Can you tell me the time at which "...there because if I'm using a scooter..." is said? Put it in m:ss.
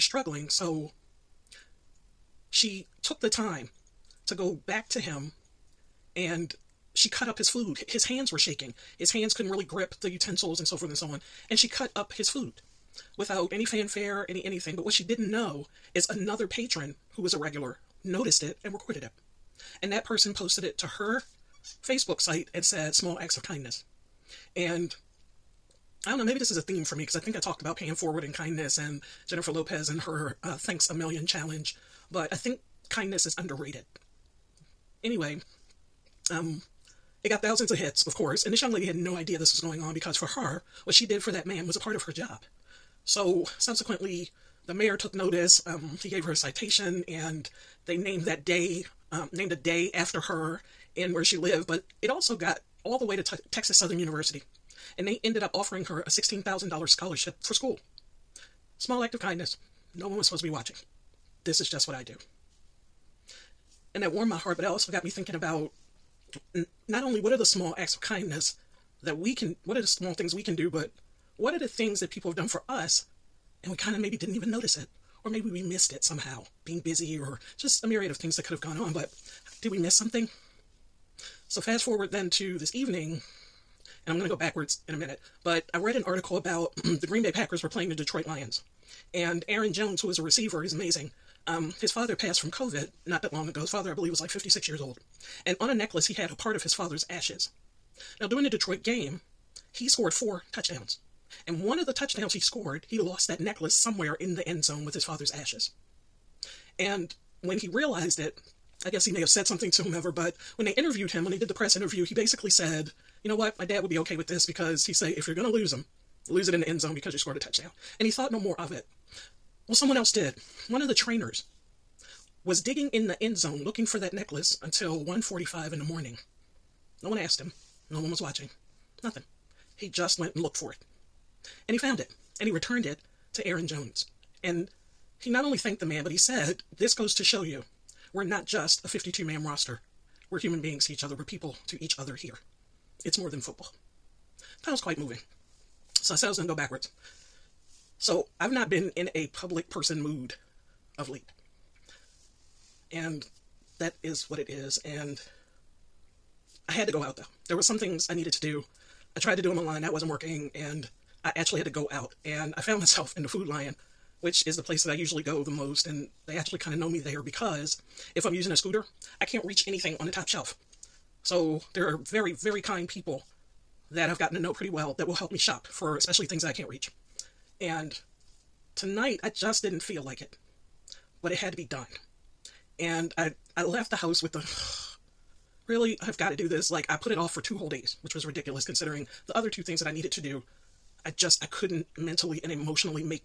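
2:46.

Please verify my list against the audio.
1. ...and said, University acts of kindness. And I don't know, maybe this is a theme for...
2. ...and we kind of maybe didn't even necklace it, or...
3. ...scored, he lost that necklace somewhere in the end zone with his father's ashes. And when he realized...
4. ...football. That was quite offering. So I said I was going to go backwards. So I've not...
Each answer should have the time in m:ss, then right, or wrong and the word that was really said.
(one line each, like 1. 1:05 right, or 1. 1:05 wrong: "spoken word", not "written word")
1. 0:22 wrong: "Small", not "University"
2. 1:13 wrong: "notice", not "necklace"
3. 1:42 right
4. 2:23 wrong: "moving", not "offering".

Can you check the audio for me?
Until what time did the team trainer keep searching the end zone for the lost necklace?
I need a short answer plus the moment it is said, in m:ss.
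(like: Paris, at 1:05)
1:45 a.m., at 2:05.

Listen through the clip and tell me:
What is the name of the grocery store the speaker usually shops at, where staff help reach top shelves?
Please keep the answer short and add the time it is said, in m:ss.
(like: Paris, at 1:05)
Food Lion, at 2:43.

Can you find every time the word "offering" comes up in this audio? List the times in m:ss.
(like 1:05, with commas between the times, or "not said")
0:55.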